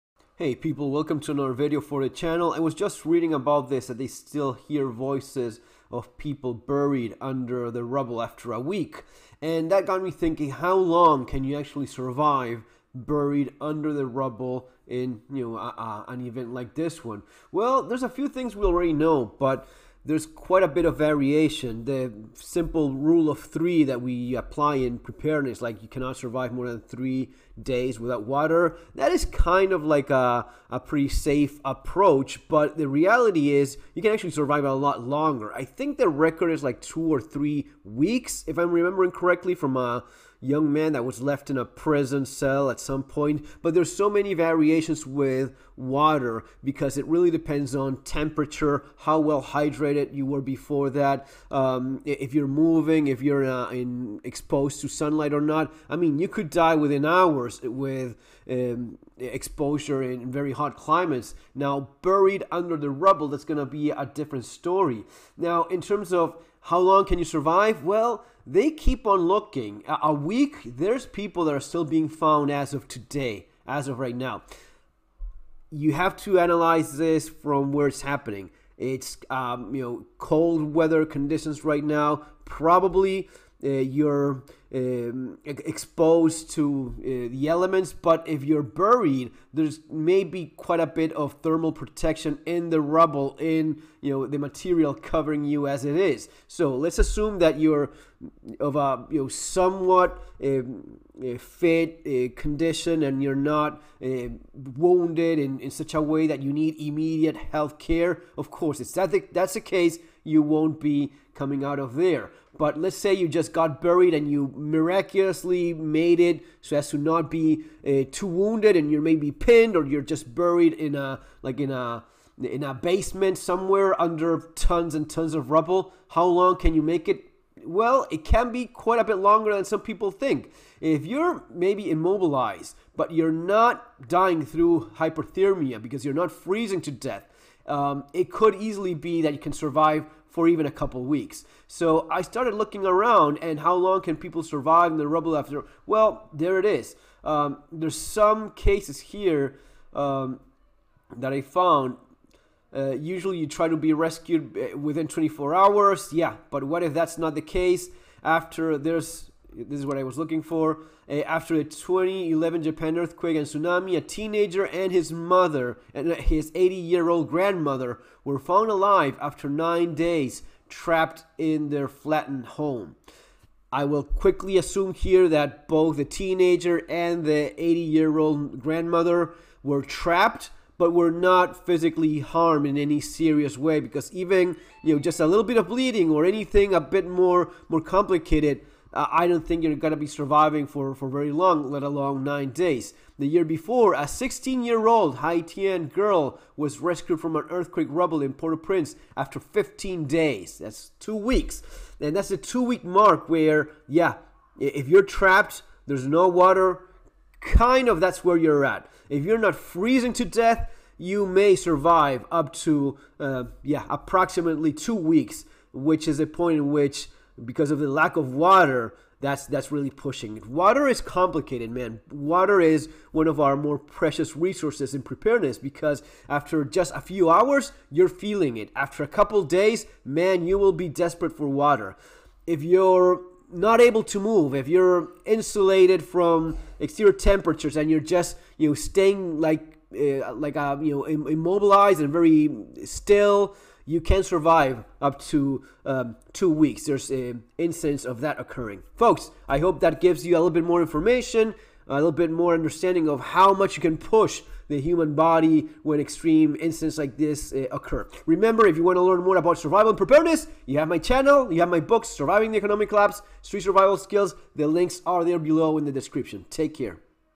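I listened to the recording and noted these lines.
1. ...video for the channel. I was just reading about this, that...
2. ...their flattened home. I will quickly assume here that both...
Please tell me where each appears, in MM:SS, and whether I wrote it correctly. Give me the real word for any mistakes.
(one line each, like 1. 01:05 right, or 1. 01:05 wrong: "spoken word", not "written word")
1. 00:01 right
2. 02:51 right.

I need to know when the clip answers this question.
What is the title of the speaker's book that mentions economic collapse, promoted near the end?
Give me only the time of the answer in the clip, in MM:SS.
04:22.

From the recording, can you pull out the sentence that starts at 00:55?
I mean, you could die within hours with um, exposure in very hot climates.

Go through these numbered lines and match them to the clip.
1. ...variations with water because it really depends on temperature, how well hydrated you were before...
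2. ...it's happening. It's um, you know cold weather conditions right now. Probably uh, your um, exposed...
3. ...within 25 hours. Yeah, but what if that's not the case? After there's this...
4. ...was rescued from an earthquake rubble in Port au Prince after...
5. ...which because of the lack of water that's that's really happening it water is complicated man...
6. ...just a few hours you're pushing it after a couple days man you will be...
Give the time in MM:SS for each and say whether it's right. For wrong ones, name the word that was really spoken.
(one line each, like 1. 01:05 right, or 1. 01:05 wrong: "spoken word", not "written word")
1. 00:44 right
2. 01:17 right
3. 02:34 wrong: "24", not "25"
4. 03:16 right
5. 03:36 wrong: "pushing", not "happening"
6. 03:46 wrong: "feeling", not "pushing".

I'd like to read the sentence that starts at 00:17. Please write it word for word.
Well, there's a few things we already know, but there's quite a bit of variation.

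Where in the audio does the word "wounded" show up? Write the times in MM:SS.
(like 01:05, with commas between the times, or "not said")
01:44, 01:58.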